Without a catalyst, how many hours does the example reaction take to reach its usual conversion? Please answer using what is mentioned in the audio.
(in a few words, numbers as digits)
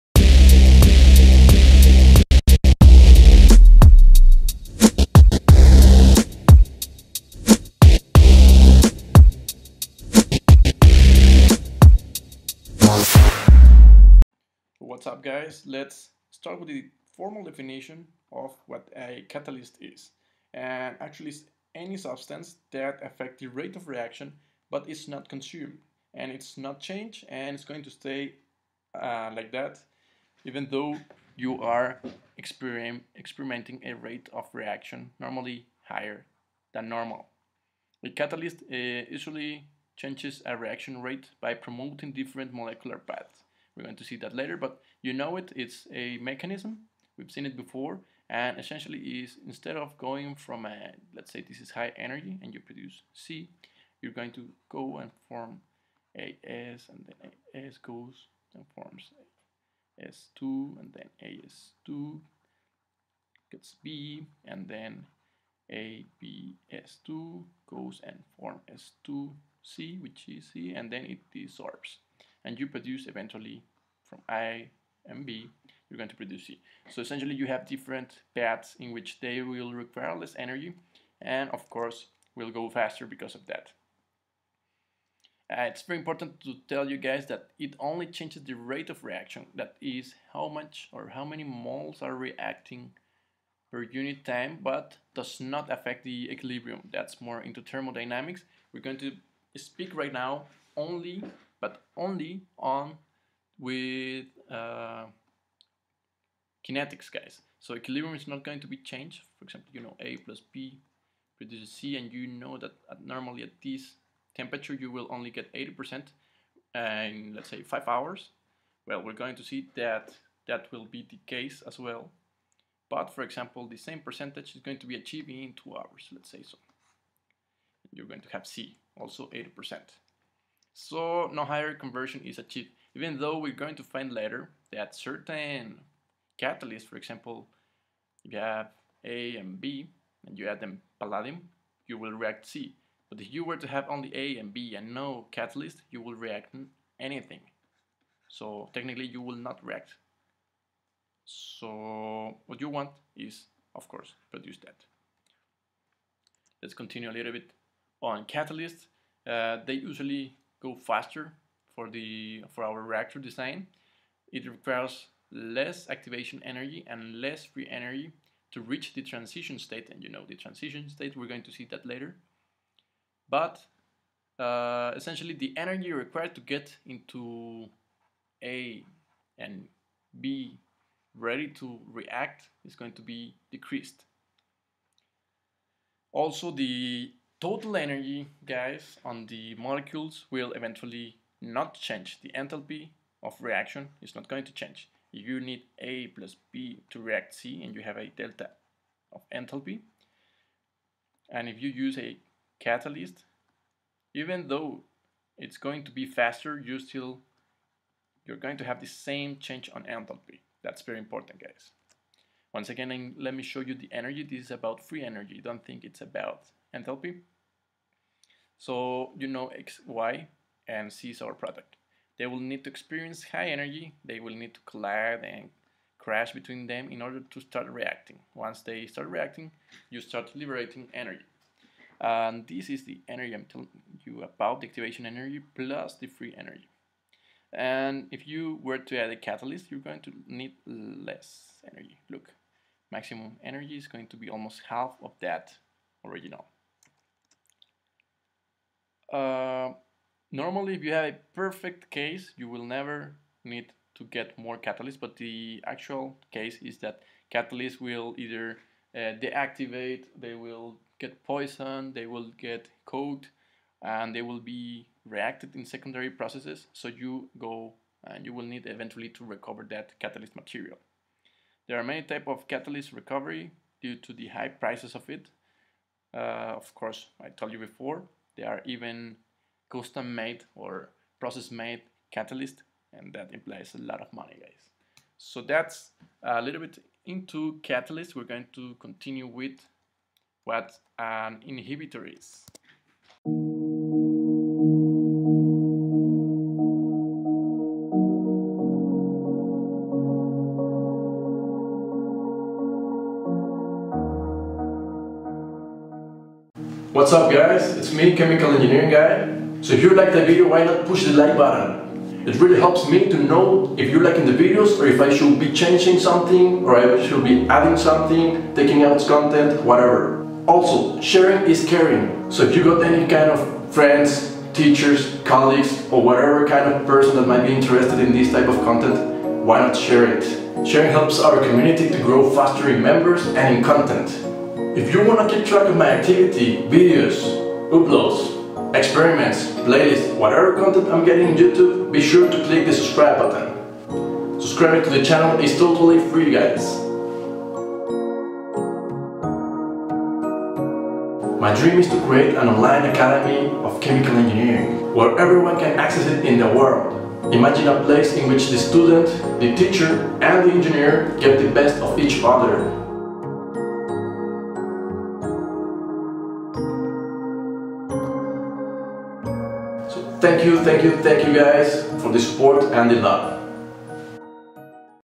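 5 hours.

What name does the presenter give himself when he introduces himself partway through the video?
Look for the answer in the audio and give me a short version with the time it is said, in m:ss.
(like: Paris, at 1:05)
Chemical Engineering Guy, at 5:08.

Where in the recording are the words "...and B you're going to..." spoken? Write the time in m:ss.
1:15.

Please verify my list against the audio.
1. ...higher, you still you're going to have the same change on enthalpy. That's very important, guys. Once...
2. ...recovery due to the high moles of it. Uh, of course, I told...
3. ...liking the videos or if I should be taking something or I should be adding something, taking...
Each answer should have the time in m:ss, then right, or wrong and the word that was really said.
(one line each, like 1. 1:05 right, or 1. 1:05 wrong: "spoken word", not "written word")
1. 3:26 wrong: "faster", not "higher"
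2. 4:32 wrong: "prices", not "moles"
3. 5:14 wrong: "changing", not "taking".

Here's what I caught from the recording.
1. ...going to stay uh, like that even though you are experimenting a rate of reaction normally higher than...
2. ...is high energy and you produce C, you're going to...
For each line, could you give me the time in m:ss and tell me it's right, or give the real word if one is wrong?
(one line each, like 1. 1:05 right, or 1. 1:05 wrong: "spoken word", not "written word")
1. 0:27 right
2. 0:51 right.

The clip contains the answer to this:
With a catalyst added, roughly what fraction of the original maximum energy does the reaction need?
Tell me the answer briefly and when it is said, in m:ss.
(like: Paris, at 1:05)
almost half, at 4:04.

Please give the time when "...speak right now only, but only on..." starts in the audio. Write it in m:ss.
1:39.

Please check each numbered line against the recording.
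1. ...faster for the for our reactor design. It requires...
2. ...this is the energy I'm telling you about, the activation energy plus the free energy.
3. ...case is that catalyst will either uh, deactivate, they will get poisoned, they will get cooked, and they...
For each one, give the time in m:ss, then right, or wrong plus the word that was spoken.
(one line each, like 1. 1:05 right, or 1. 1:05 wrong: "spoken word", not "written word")
1. 2:40 right
2. 3:52 right
3. 4:16 right.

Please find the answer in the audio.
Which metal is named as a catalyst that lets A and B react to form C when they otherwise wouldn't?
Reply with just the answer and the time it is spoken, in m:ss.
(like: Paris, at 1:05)
palladium, at 2:20.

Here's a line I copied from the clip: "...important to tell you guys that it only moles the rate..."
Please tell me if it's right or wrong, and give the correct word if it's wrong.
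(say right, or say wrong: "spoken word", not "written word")
wrong: "changes", not "moles".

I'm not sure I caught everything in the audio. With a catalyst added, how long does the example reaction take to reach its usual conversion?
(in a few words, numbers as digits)
2 hours.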